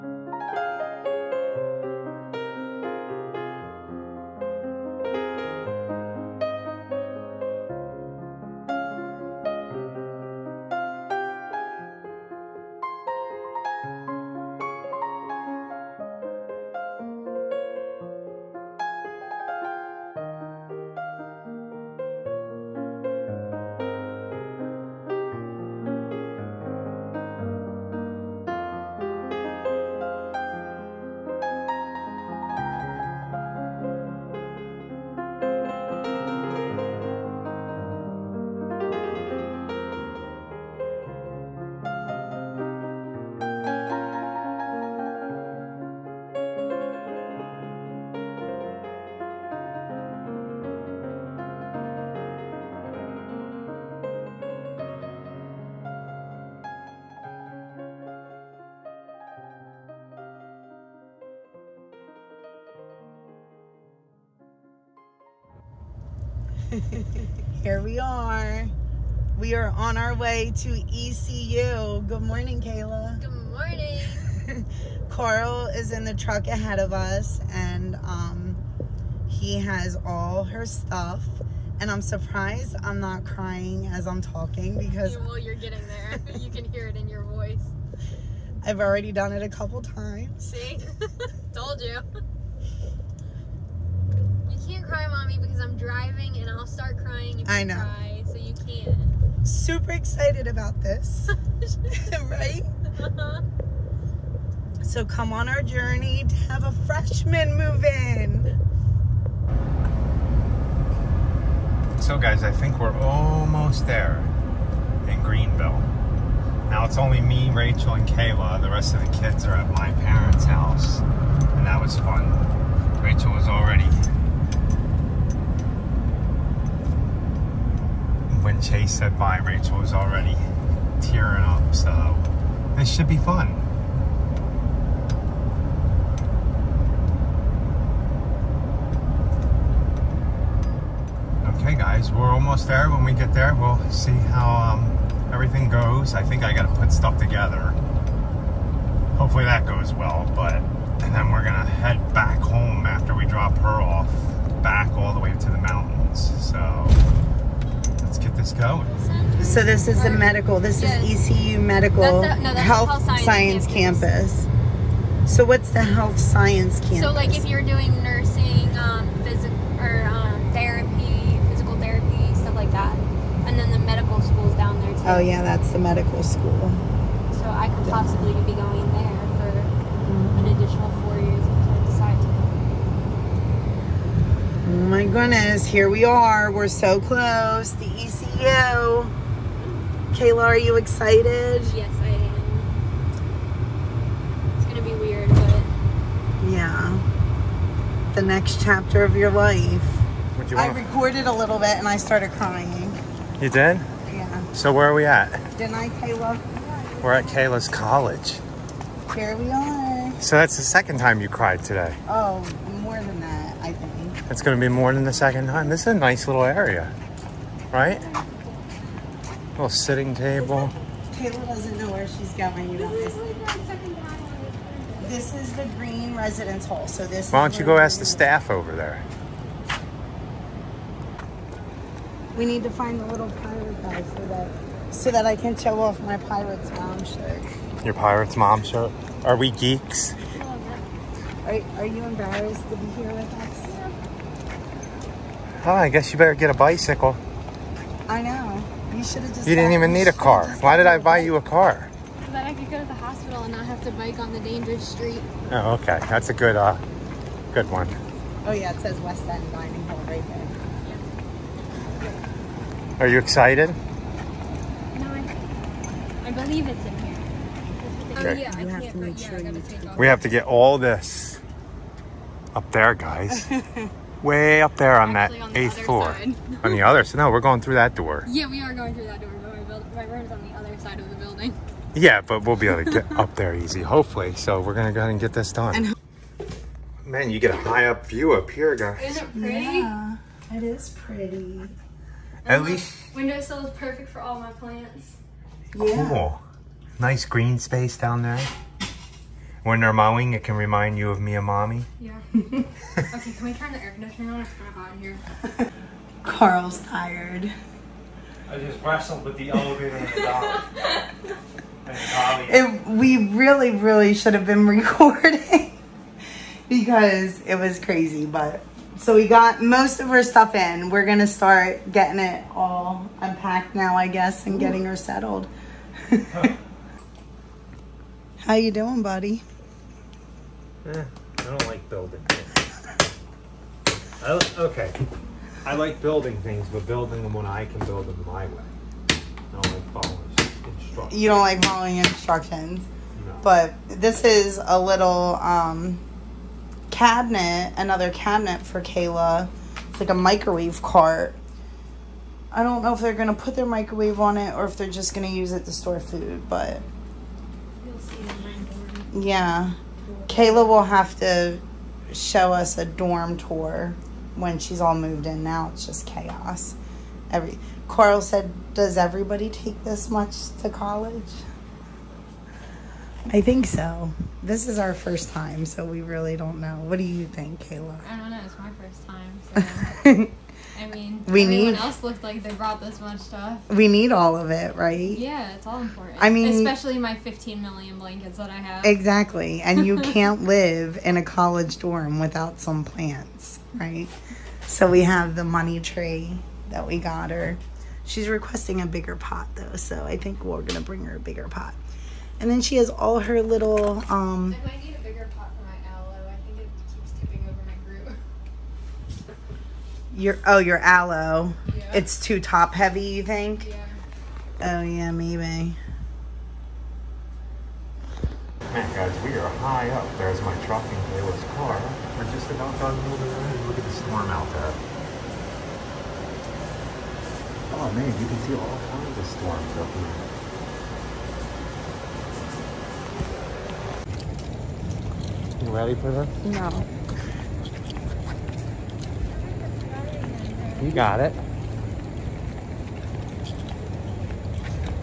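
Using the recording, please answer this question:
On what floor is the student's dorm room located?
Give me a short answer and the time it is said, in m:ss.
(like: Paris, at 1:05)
8th, at 4:35.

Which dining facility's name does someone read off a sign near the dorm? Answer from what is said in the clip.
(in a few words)
West End Dining Hall.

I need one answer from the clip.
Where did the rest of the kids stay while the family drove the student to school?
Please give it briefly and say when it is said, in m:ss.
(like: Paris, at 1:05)
My parents' house, at 1:59.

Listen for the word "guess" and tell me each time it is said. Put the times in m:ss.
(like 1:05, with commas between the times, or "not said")
4:05, 5:24.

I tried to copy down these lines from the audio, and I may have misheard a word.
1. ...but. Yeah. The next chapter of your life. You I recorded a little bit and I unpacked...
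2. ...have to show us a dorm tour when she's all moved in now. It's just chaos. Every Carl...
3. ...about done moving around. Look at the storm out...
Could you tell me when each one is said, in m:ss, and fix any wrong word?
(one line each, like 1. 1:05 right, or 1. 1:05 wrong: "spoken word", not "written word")
1. 3:15 wrong: "started", not "unpacked"
2. 6:00 right
3. 7:02 right.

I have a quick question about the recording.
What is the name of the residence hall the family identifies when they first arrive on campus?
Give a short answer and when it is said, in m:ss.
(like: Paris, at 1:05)
Green residence hall, at 3:45.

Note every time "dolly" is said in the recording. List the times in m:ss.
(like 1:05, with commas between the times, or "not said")
5:12.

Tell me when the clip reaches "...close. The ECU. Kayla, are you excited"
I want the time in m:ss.
3:07.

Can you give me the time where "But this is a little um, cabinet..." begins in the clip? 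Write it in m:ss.
5:43.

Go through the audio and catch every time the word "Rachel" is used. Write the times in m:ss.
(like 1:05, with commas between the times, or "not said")
1:57, 2:03, 2:09.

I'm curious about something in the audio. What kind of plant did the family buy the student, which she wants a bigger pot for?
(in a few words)
Money tree.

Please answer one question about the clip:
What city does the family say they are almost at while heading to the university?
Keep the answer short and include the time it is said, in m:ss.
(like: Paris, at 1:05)
Greenville, at 1:55.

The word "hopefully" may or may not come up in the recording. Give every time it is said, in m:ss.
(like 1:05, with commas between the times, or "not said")
2:29, 4:43.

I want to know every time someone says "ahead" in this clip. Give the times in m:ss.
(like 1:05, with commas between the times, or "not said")
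1:16, 4:45.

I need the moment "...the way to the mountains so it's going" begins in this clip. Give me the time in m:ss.
2:35.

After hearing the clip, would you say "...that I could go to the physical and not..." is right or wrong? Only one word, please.
wrong.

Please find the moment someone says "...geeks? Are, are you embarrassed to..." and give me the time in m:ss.
3:59.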